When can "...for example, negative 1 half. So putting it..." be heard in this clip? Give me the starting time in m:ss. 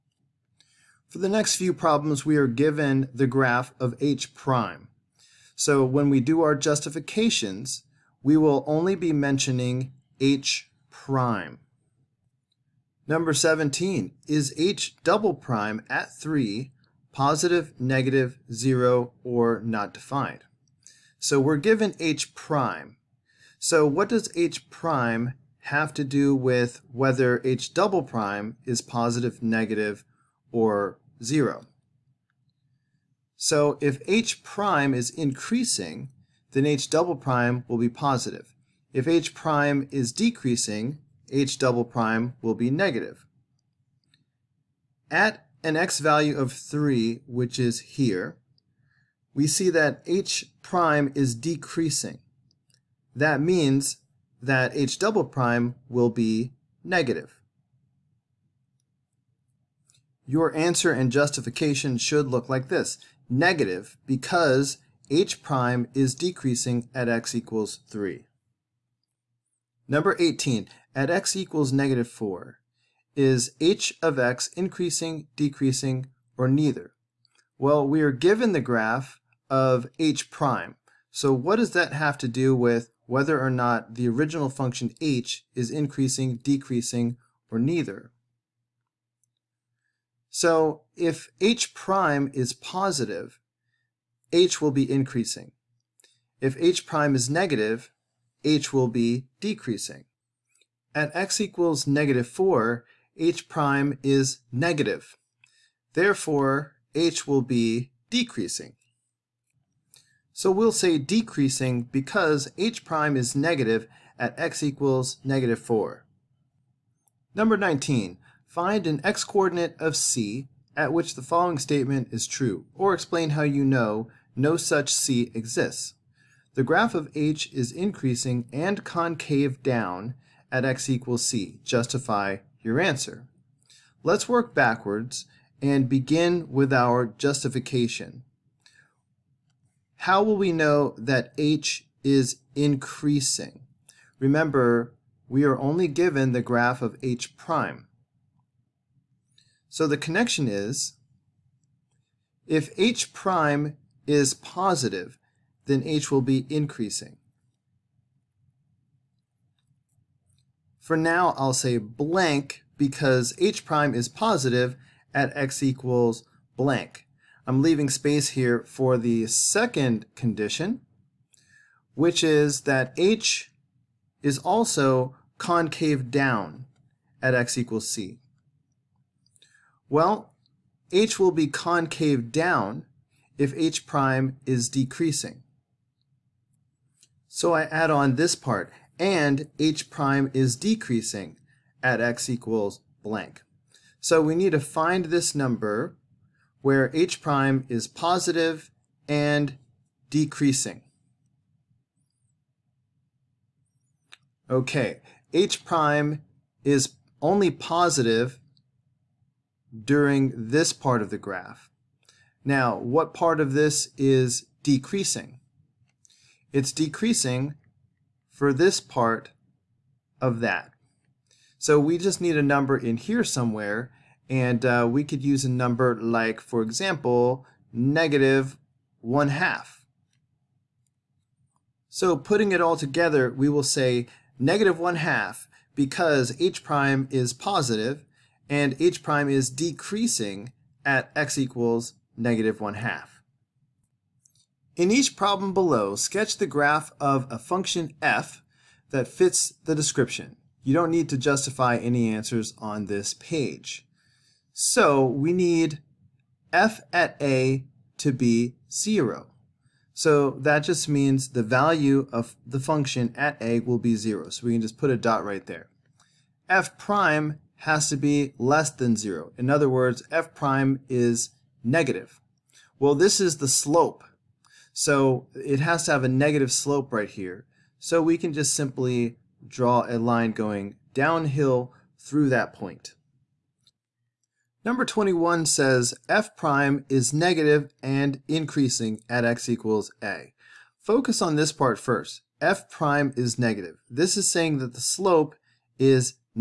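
3:46.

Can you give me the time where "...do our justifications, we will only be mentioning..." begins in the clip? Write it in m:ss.
0:06.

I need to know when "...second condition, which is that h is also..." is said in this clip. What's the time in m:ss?
2:49.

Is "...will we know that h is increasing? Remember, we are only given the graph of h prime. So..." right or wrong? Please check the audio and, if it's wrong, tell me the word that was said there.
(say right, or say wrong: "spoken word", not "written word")
right.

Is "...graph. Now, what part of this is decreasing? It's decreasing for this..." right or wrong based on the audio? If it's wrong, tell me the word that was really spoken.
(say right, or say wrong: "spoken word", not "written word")
right.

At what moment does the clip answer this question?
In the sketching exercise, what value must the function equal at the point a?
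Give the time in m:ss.
4:16.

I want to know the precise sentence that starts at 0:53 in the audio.
That means that h double prime will be negative.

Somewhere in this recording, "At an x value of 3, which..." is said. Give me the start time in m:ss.
0:45.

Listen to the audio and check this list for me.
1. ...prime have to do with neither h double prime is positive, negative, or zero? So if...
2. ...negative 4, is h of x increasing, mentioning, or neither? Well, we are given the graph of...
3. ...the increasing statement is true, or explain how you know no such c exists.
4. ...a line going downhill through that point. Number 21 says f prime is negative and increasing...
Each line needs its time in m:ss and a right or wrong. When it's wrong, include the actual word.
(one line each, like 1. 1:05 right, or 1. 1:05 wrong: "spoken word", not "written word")
1. 0:24 wrong: "whether", not "neither"
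2. 1:11 wrong: "decreasing", not "mentioning"
3. 2:01 wrong: "following", not "increasing"
4. 4:39 right.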